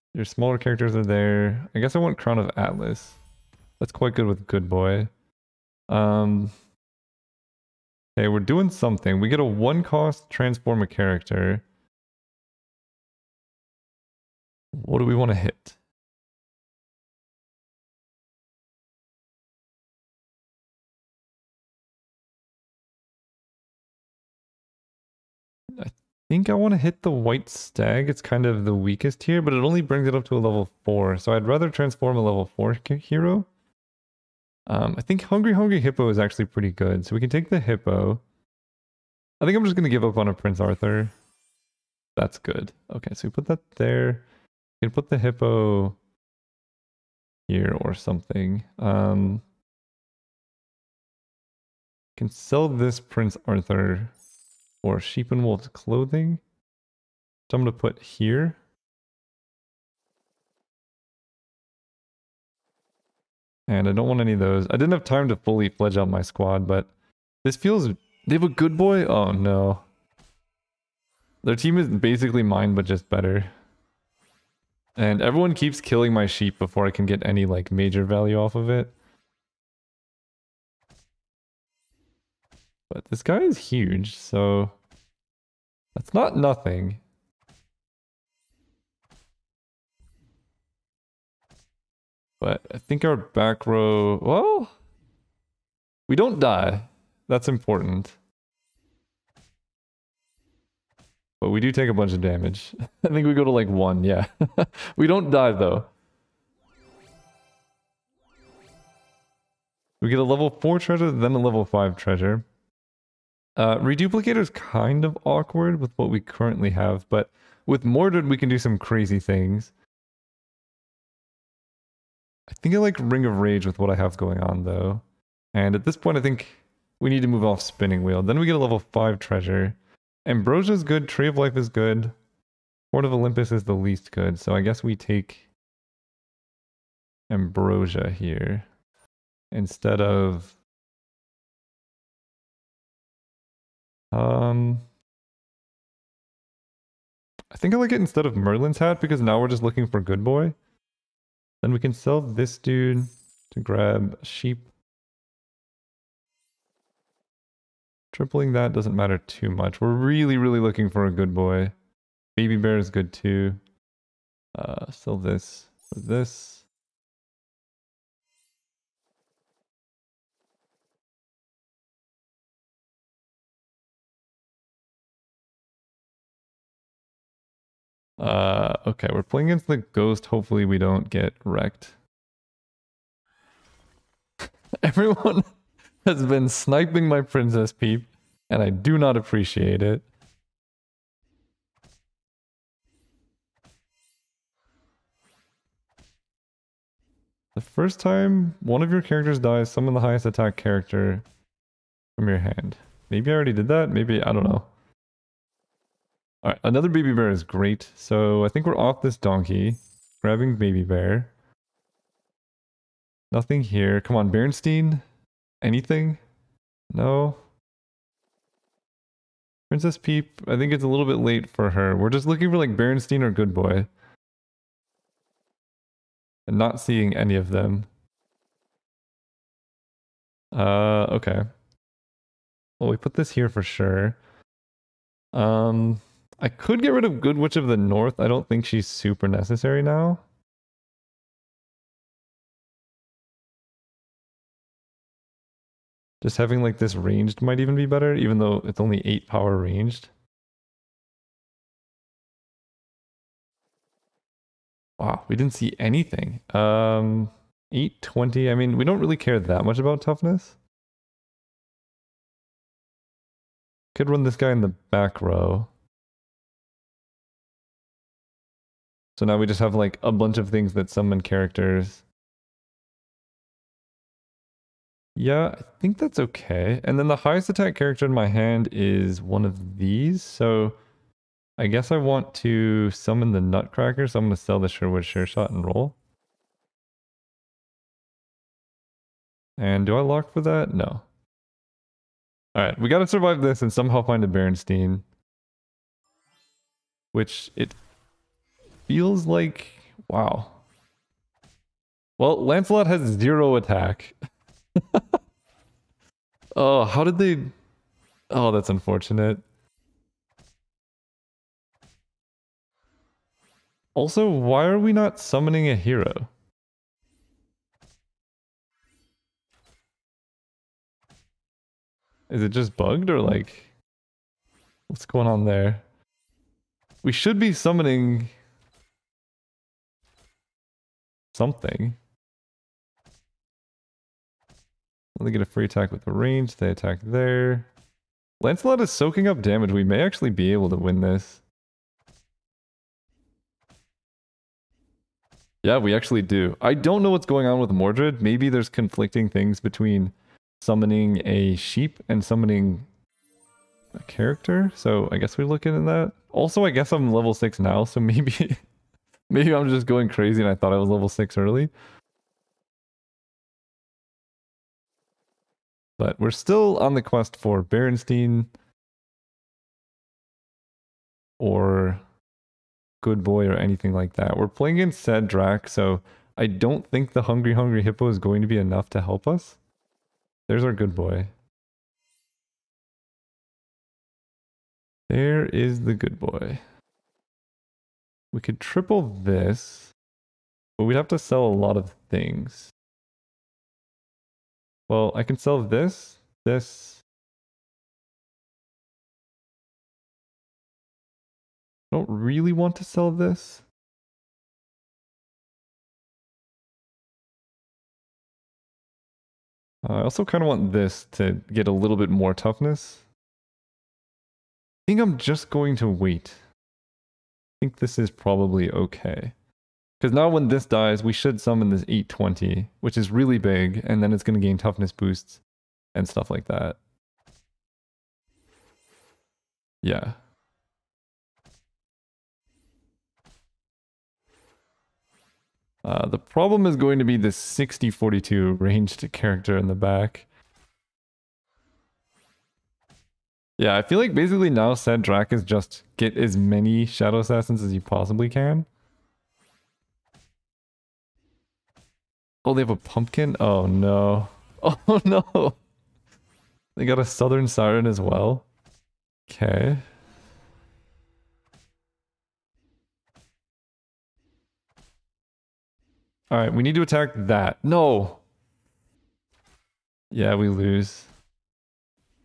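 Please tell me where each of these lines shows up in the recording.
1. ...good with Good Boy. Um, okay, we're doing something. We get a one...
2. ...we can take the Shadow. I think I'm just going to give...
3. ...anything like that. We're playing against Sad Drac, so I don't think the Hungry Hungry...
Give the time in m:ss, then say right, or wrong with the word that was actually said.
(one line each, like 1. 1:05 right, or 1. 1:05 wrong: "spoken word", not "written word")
1. 0:04 right
2. 0:37 wrong: "Hippo", not "Shadow"
3. 6:13 right.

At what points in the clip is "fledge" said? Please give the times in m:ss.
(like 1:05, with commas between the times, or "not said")
1:05.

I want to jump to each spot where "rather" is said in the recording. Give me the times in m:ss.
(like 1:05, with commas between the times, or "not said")
0:31.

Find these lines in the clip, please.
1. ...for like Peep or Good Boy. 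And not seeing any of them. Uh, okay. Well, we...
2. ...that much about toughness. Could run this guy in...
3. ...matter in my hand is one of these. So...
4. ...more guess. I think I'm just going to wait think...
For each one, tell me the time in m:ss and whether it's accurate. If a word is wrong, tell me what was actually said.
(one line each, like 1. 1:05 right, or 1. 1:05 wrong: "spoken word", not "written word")
1. 3:42 wrong: "Bearstine", not "Peep"
2. 4:19 right
3. 4:37 wrong: "character", not "matter"
4. 6:52 wrong: "toughness", not "guess".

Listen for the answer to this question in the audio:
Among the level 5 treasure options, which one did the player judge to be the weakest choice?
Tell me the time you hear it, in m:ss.
2:12.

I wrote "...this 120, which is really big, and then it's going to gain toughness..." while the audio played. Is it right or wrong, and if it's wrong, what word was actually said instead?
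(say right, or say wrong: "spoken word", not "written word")
wrong: "820", not "120".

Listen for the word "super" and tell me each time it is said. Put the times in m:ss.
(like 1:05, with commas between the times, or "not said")
3:58.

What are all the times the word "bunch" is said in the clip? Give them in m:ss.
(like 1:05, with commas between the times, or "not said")
1:41, 4:30.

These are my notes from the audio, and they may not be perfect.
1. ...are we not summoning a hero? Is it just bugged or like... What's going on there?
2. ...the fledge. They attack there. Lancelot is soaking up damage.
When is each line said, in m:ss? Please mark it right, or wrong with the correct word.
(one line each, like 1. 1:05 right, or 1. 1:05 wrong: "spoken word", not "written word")
1. 5:14 right
2. 5:36 wrong: "range", not "fledge".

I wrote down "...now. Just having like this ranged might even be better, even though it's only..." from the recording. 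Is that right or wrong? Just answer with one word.
right.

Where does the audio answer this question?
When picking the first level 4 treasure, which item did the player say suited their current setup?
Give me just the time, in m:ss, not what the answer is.
2:02.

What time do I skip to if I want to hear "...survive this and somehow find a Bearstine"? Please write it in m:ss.
4:53.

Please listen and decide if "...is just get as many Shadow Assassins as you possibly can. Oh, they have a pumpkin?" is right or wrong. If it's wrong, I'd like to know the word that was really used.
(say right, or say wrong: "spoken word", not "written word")
right.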